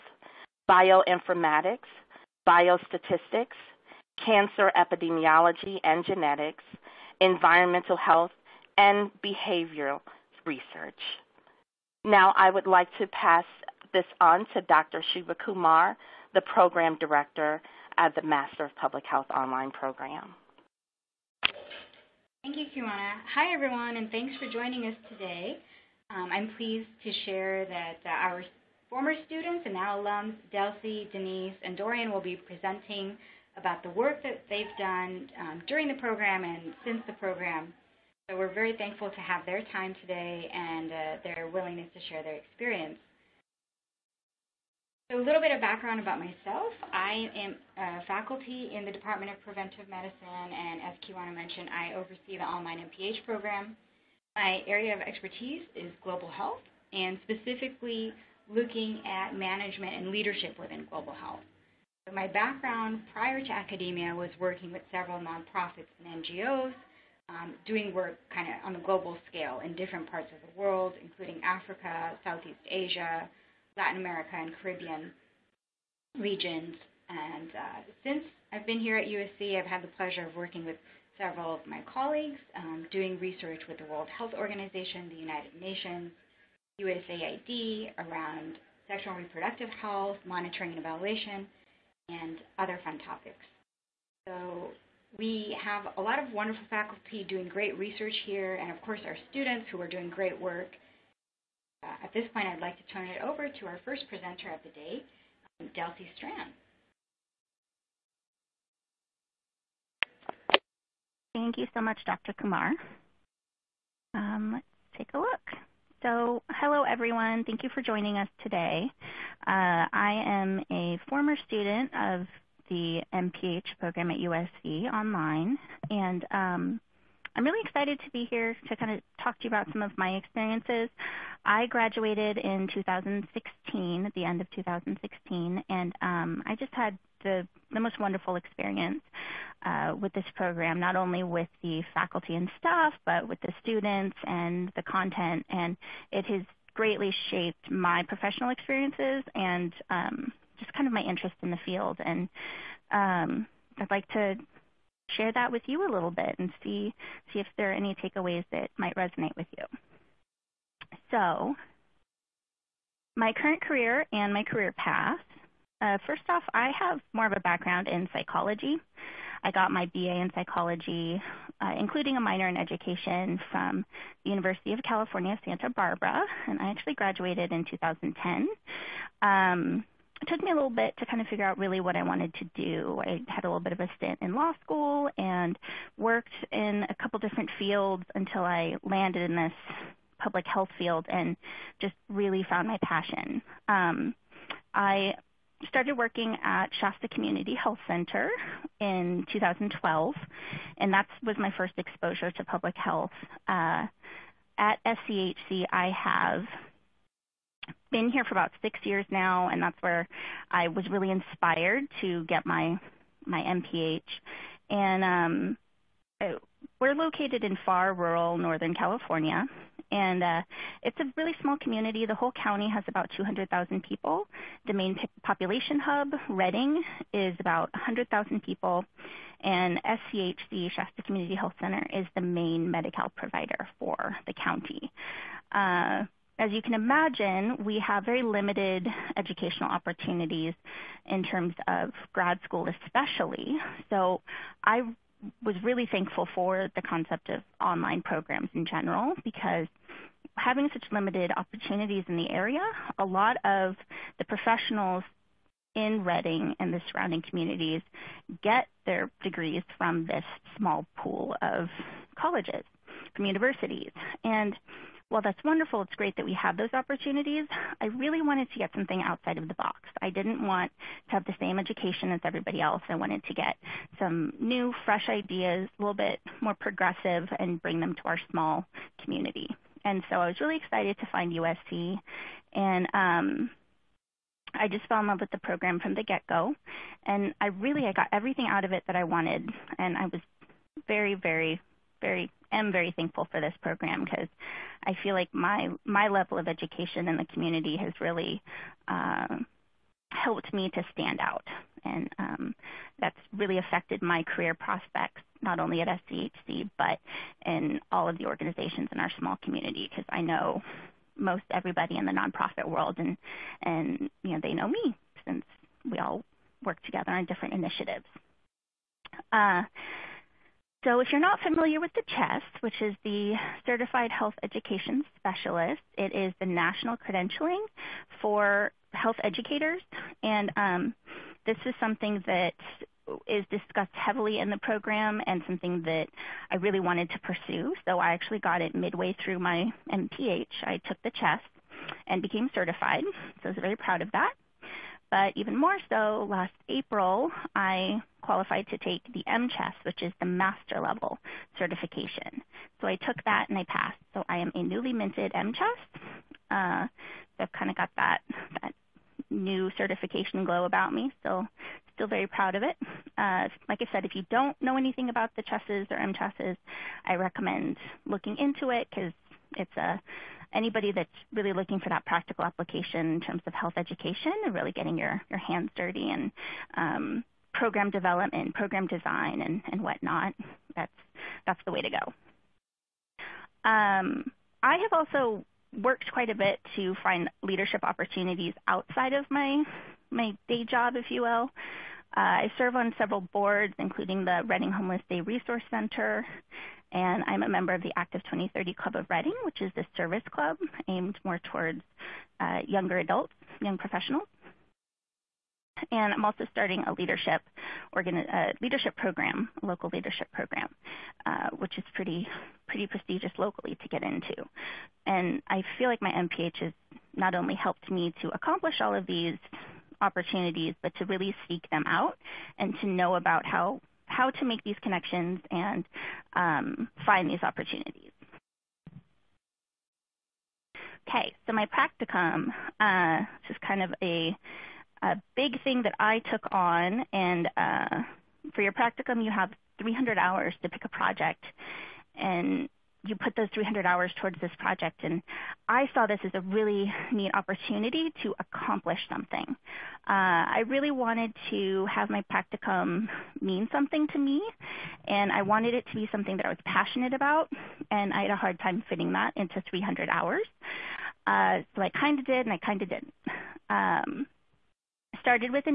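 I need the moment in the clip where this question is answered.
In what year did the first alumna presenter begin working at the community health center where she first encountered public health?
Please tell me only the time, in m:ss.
3:19.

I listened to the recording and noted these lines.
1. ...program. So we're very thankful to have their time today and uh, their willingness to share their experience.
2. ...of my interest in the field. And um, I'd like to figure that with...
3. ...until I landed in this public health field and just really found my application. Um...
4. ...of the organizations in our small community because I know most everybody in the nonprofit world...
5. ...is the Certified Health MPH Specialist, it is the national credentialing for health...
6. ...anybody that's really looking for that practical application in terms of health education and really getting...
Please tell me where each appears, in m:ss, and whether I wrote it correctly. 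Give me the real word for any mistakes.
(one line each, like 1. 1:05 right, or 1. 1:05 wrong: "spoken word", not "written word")
1. 0:37 right
2. 2:30 wrong: "share", not "figure"
3. 3:08 wrong: "passion", not "application"
4. 5:08 right
5. 5:22 wrong: "Education", not "MPH"
6. 6:10 right.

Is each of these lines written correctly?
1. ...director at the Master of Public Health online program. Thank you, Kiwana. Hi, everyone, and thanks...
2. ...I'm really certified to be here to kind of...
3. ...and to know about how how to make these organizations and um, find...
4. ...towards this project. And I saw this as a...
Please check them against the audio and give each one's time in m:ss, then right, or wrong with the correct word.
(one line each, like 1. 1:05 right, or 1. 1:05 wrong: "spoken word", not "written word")
1. 0:16 right
2. 2:07 wrong: "excited", not "certified"
3. 7:02 wrong: "connections", not "organizations"
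4. 7:24 right.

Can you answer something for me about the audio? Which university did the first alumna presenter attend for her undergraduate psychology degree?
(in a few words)
University of California, Santa Barbara.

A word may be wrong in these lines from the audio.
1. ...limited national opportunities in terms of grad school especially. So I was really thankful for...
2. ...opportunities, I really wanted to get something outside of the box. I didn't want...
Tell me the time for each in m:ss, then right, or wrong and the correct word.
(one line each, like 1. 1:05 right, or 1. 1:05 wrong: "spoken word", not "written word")
1. 3:58 wrong: "educational", not "national"
2. 4:26 right.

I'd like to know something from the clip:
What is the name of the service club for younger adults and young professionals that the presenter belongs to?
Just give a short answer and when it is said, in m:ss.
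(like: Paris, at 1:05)
Active 2030 Club, at 6:37.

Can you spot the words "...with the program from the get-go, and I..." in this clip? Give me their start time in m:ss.
4:45.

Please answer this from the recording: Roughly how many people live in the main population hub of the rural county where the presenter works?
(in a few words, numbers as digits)
100,000.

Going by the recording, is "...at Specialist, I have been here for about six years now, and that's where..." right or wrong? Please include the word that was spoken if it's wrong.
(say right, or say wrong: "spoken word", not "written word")
wrong: "SCHC", not "Specialist".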